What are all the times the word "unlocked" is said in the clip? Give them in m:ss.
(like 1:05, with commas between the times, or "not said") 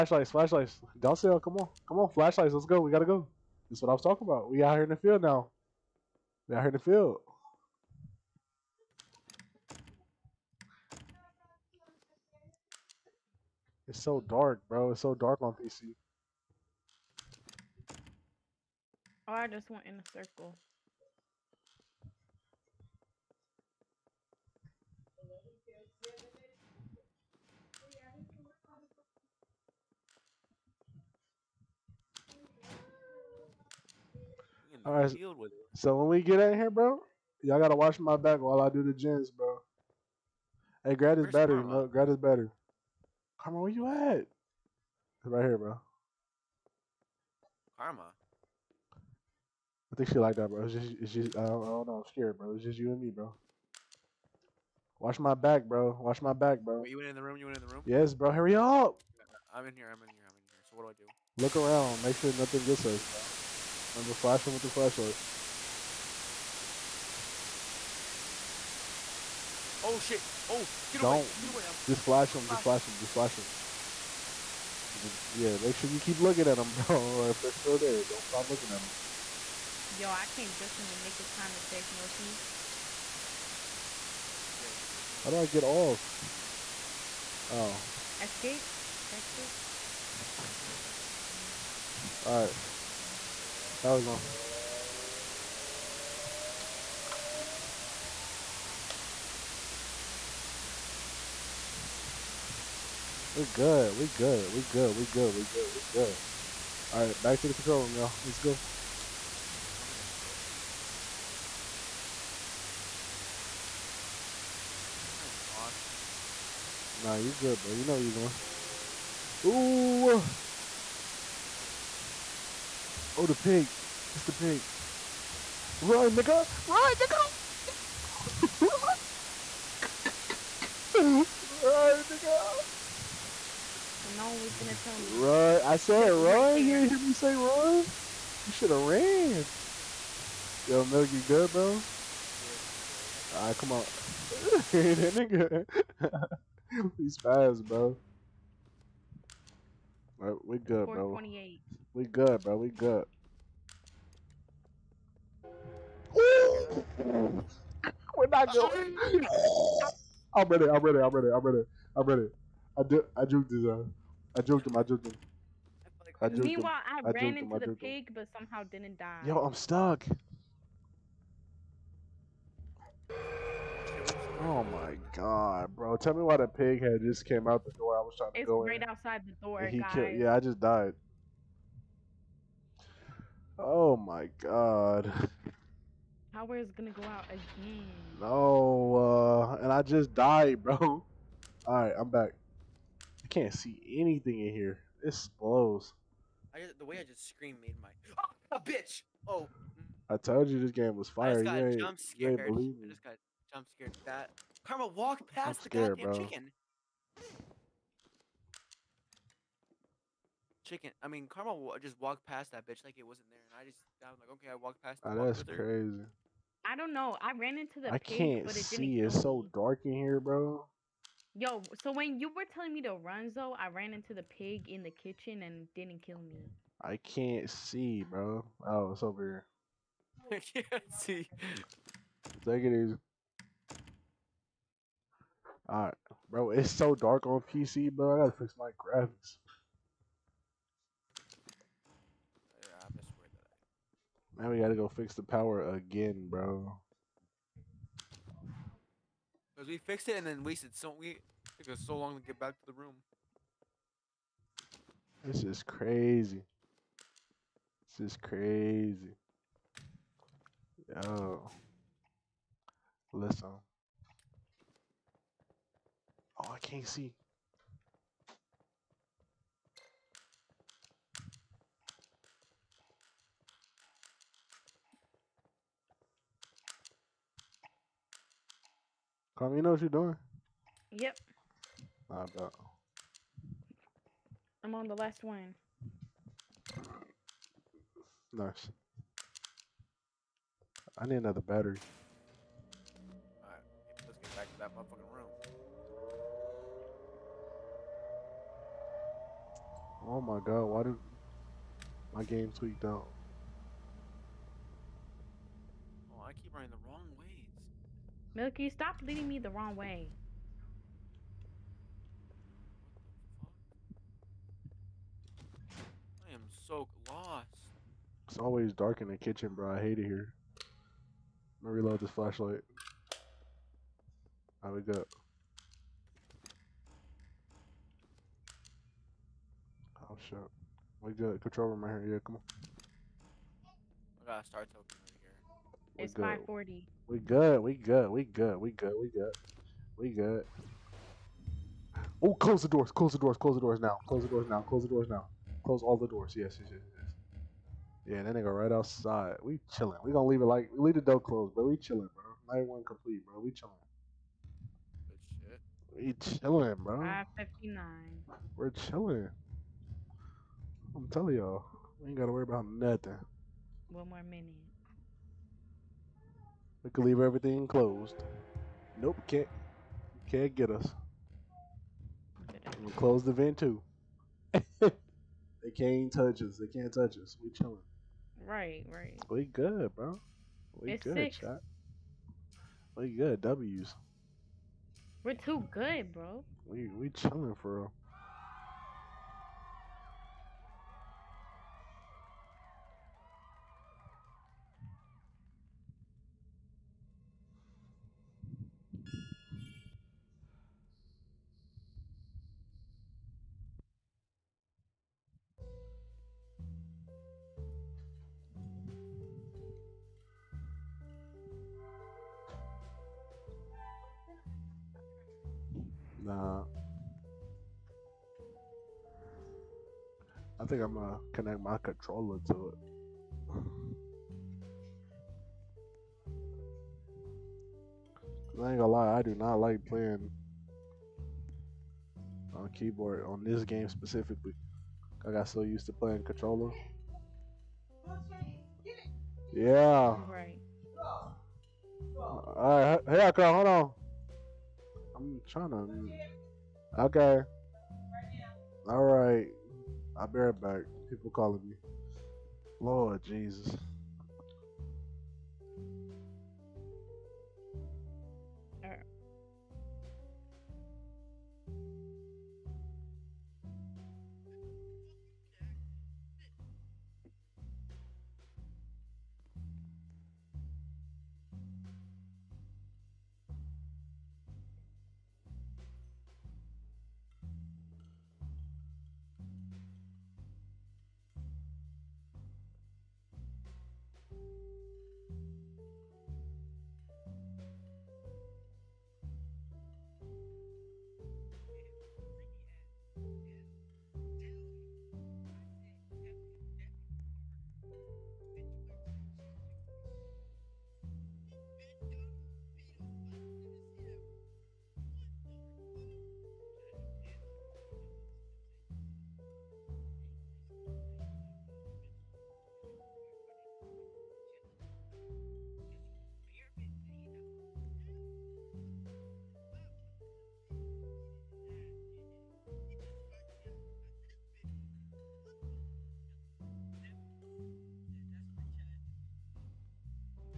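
not said.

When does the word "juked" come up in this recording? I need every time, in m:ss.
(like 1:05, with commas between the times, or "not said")
2:43.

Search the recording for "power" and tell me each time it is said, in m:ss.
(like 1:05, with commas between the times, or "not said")
1:33, 3:06, 4:05.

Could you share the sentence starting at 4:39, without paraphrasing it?
Come, you know what you're doing?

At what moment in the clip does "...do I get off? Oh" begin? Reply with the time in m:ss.
1:25.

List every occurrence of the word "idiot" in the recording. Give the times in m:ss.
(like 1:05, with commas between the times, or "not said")
not said.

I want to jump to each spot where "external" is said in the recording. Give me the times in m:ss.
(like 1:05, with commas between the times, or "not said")
not said.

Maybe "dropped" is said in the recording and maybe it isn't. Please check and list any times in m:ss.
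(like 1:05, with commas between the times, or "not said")
not said.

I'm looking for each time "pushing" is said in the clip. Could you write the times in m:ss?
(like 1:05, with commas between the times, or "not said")
not said.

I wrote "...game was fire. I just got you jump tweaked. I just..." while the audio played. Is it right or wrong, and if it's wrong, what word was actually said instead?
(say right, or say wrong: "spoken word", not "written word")
wrong: "scared", not "tweaked".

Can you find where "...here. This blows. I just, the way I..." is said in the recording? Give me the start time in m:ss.
3:14.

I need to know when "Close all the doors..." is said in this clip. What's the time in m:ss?
5:45.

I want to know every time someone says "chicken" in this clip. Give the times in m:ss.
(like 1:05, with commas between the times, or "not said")
3:26, 3:30.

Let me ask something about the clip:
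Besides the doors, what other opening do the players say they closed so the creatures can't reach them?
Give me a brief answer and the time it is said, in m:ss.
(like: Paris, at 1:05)
The vent, at 6:12.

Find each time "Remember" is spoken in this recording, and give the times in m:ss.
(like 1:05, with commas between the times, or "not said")
1:03.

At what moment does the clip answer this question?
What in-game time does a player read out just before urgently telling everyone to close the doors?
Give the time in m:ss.
5:36.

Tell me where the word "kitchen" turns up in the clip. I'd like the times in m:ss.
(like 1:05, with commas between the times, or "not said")
3:44, 5:19.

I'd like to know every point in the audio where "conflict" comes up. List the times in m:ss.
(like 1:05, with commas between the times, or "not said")
not said.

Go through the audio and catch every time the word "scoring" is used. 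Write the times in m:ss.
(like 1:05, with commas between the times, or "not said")
not said.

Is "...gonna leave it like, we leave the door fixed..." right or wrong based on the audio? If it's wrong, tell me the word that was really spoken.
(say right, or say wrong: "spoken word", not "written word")
wrong: "closed", not "fixed".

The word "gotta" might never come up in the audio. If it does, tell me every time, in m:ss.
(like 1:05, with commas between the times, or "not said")
0:02, 0:37, 3:58, 4:04, 5:34, 6:02.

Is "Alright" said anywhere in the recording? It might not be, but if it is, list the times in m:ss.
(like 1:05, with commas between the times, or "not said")
1:32, 3:55, 4:52.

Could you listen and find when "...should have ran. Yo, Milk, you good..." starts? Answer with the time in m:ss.
2:18.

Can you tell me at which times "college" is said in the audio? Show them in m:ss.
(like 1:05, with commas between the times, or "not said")
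not said.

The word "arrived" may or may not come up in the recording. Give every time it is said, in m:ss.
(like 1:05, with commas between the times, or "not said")
not said.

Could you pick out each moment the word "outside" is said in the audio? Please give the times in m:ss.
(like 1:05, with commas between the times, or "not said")
2:58, 5:48.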